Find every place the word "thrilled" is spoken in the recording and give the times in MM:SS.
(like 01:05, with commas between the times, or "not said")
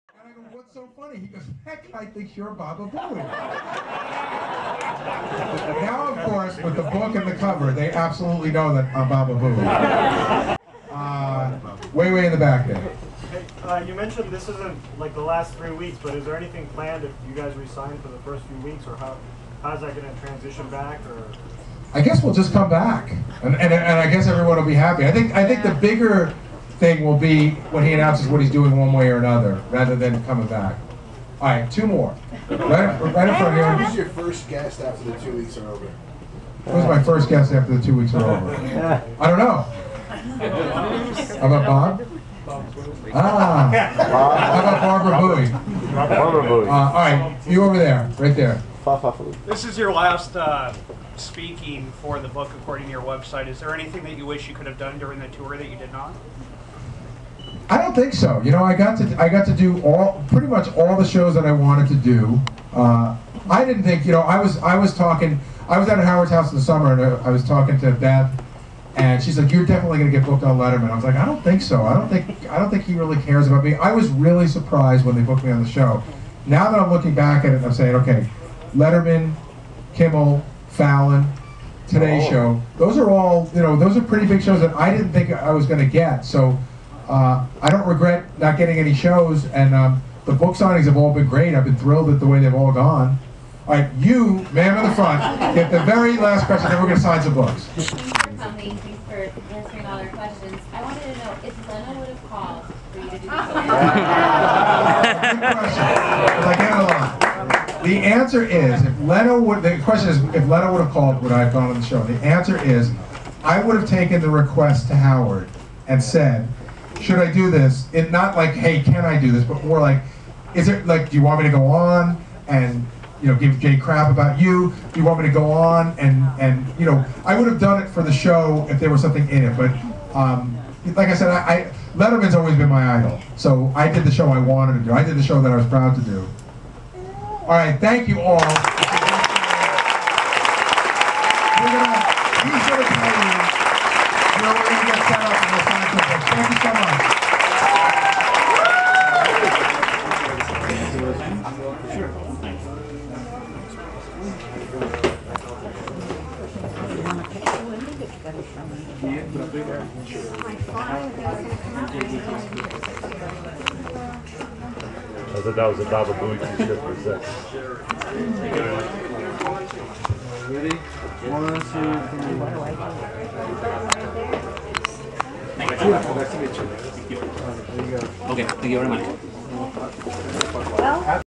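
01:31.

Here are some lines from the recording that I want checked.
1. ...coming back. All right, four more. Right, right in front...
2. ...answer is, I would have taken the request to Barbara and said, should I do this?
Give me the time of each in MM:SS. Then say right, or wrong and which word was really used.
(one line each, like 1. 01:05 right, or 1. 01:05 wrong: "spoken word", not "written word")
1. 00:30 wrong: "two", not "four"
2. 01:52 wrong: "Howard", not "Barbara".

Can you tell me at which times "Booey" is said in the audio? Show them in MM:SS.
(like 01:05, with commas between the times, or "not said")
00:02, 00:09, 02:46.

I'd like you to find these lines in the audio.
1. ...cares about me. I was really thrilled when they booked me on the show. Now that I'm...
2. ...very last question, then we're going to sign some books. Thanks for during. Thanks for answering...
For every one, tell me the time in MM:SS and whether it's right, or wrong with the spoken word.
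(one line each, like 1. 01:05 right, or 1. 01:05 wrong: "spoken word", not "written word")
1. 01:13 wrong: "surprised", not "thrilled"
2. 01:35 wrong: "coming", not "during".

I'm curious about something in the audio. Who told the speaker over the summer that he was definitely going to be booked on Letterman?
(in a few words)
Beth.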